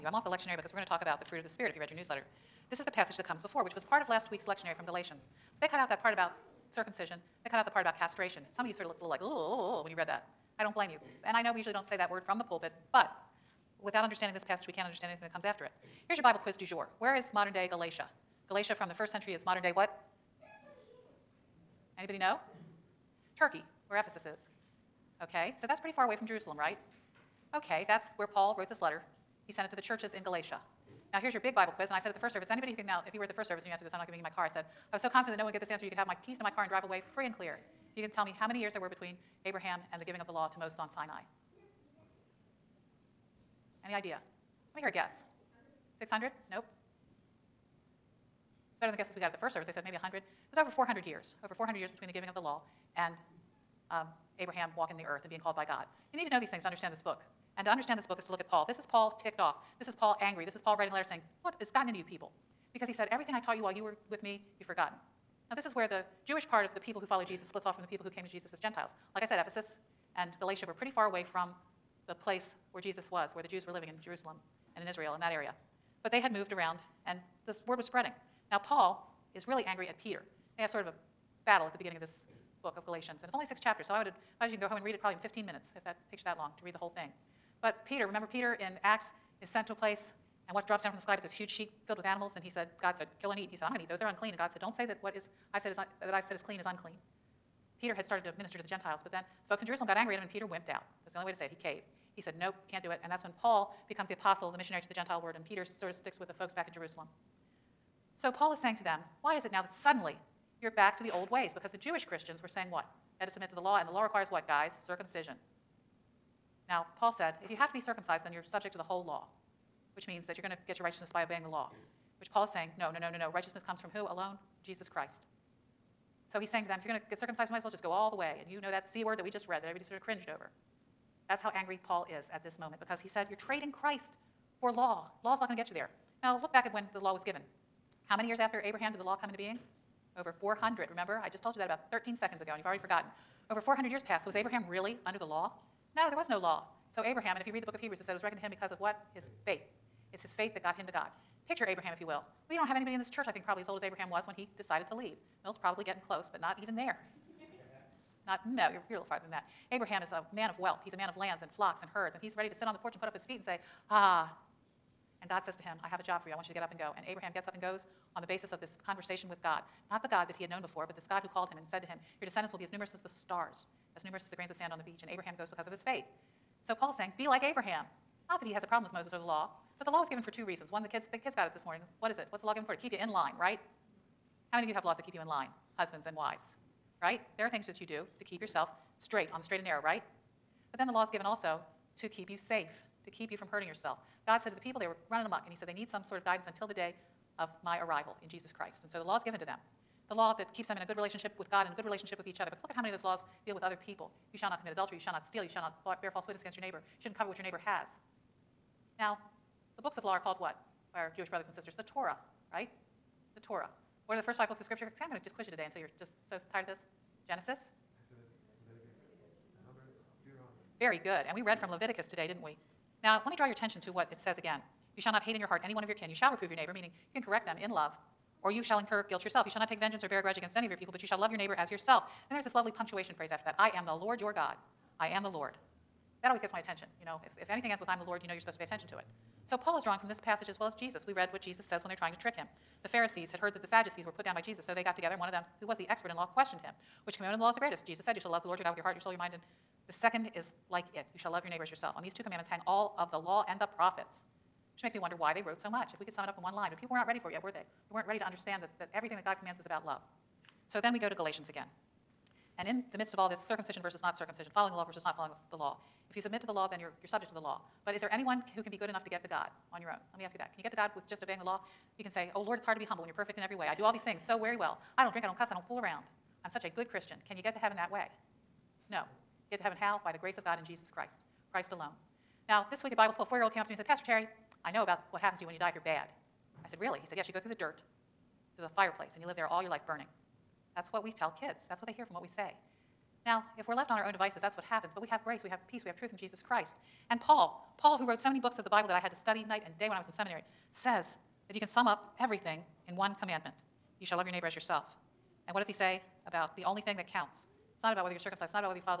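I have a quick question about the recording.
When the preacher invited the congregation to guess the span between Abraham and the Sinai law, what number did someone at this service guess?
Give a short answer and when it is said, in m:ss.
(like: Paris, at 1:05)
600, at 0:45.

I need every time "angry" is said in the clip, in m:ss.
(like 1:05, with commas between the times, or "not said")
1:00, 1:19, 1:39, 2:11.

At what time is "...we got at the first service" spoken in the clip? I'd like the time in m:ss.
0:49.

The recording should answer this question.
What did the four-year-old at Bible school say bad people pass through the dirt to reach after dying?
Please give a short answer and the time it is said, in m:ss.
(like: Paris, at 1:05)
The fireplace, at 4:48.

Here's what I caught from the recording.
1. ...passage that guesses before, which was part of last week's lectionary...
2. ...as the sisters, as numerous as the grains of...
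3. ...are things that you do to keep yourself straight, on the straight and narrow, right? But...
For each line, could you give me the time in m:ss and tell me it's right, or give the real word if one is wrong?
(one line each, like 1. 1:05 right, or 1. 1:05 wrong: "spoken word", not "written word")
1. 0:02 wrong: "comes", not "guesses"
2. 2:52 wrong: "stars", not "sisters"
3. 3:07 right.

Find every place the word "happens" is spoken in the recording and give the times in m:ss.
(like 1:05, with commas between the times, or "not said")
4:45, 4:54.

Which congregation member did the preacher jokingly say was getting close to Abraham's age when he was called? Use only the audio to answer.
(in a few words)
Milt.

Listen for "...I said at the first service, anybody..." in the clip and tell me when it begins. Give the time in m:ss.
0:31.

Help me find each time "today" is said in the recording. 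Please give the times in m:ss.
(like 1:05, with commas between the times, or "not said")
3:35, 3:42.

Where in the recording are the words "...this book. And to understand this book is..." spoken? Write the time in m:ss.
0:56.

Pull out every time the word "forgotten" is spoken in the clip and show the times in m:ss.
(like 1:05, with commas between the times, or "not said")
1:04, 2:22.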